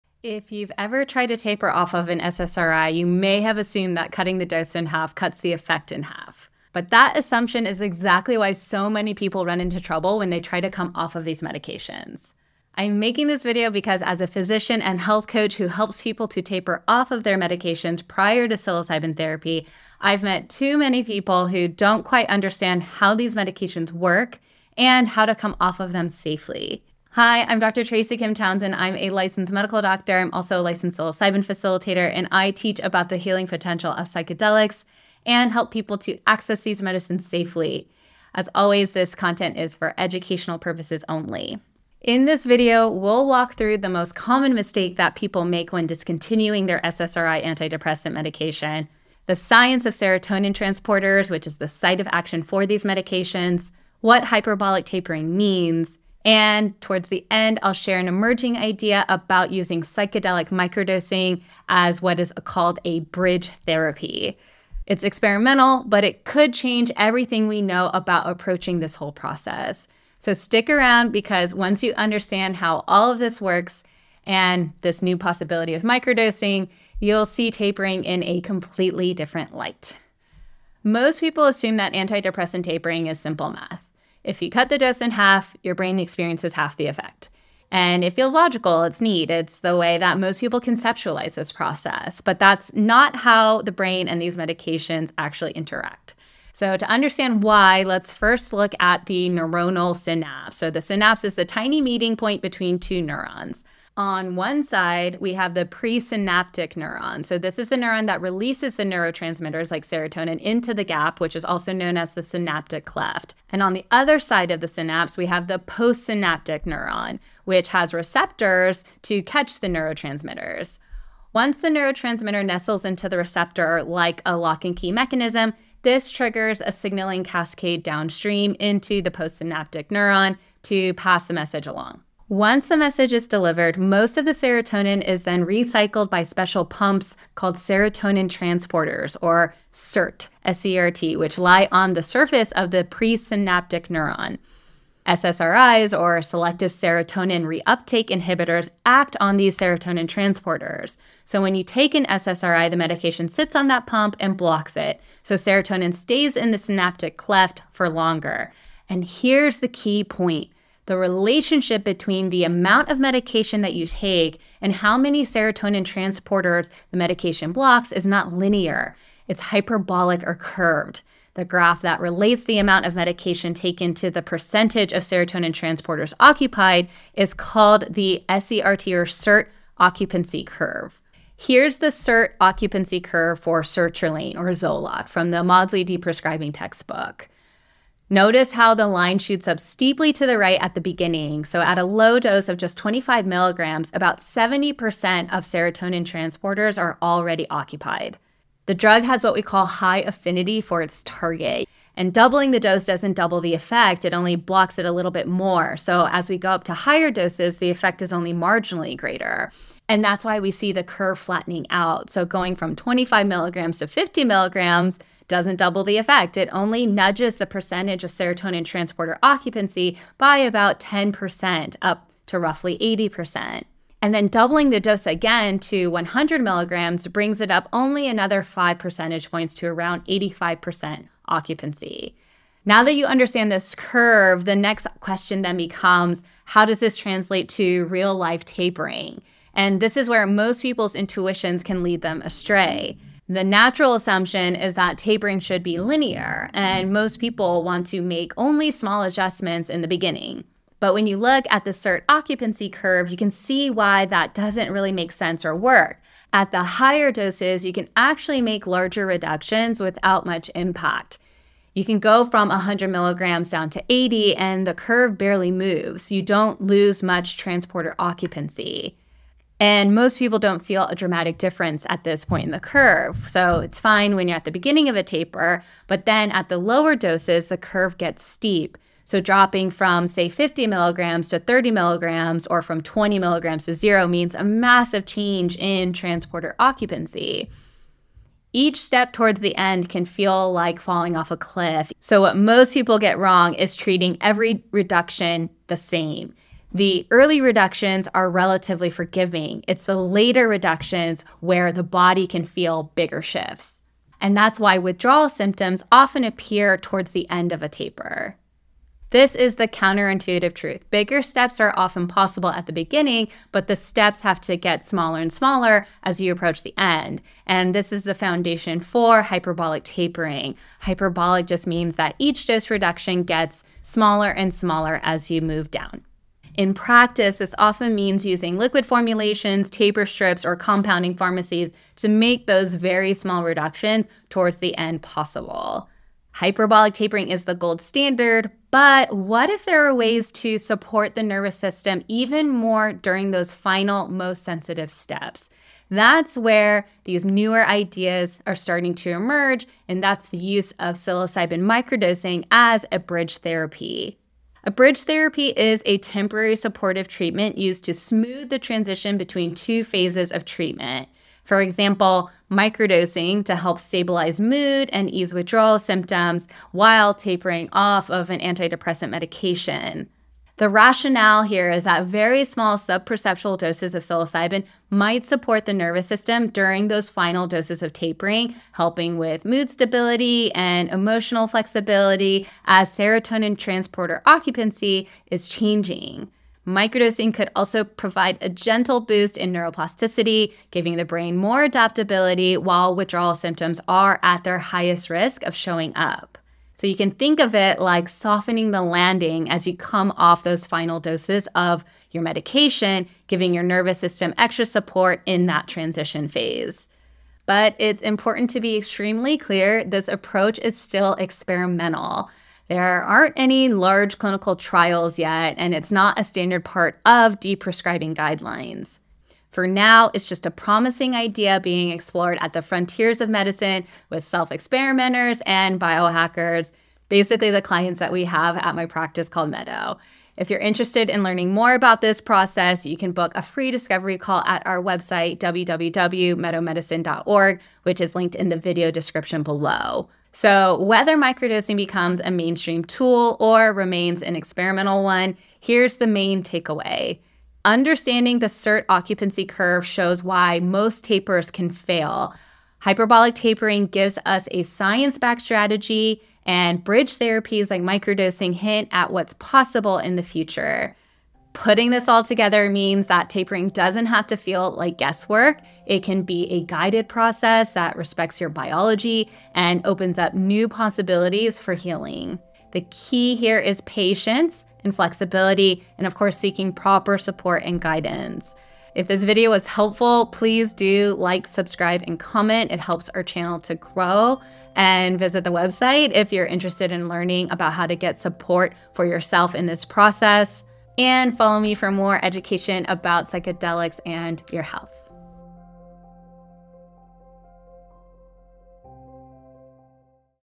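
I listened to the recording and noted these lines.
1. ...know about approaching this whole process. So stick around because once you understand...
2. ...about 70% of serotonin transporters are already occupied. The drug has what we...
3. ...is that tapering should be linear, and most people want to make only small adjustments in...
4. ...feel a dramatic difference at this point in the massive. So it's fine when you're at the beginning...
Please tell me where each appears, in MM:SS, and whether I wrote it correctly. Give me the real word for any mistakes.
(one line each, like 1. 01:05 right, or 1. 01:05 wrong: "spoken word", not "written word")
1. 01:07 right
2. 03:13 right
3. 04:04 right
4. 04:30 wrong: "curve", not "massive".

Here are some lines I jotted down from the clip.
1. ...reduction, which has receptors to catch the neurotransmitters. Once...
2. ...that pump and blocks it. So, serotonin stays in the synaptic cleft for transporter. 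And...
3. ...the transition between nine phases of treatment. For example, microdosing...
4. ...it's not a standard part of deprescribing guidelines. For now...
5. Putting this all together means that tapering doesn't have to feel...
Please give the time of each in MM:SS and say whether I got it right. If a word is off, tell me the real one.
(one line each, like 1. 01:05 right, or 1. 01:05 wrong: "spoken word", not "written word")
1. 01:56 wrong: "neuron", not "reduction"
2. 02:33 wrong: "longer", not "transporter"
3. 05:58 wrong: "two", not "nine"
4. 06:55 right
5. 07:41 right.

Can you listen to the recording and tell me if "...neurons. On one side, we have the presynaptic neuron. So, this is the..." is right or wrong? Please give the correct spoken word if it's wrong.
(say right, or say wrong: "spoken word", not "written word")
right.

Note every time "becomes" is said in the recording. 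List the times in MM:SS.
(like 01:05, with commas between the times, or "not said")
03:55, 07:21.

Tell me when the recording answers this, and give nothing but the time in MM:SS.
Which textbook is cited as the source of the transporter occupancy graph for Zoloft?
03:05.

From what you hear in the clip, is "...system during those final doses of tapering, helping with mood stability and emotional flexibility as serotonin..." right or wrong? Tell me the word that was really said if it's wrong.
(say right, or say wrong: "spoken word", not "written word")
right.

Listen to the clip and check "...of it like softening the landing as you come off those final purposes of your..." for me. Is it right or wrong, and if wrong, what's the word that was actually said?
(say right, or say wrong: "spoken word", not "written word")
wrong: "doses", not "purposes".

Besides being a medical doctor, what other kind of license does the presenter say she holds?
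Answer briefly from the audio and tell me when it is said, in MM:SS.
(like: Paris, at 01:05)
psilocybin facilitator, at 00:30.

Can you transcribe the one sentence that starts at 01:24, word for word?
If you cut the dose in half, your brain experiences half the effect.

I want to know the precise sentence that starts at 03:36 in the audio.
It only nudges the percentage of serotonin transporter occupancy by about 10% up to roughly 80%.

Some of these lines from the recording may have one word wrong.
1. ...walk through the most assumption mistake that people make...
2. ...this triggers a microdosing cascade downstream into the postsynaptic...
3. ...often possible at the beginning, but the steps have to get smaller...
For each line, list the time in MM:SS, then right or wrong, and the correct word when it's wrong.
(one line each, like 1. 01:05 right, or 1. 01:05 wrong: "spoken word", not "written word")
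1. 00:43 wrong: "common", not "assumption"
2. 02:05 wrong: "signaling", not "microdosing"
3. 05:11 right.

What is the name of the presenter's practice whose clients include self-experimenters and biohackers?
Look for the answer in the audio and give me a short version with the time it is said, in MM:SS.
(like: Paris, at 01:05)
Meadow, at 07:09.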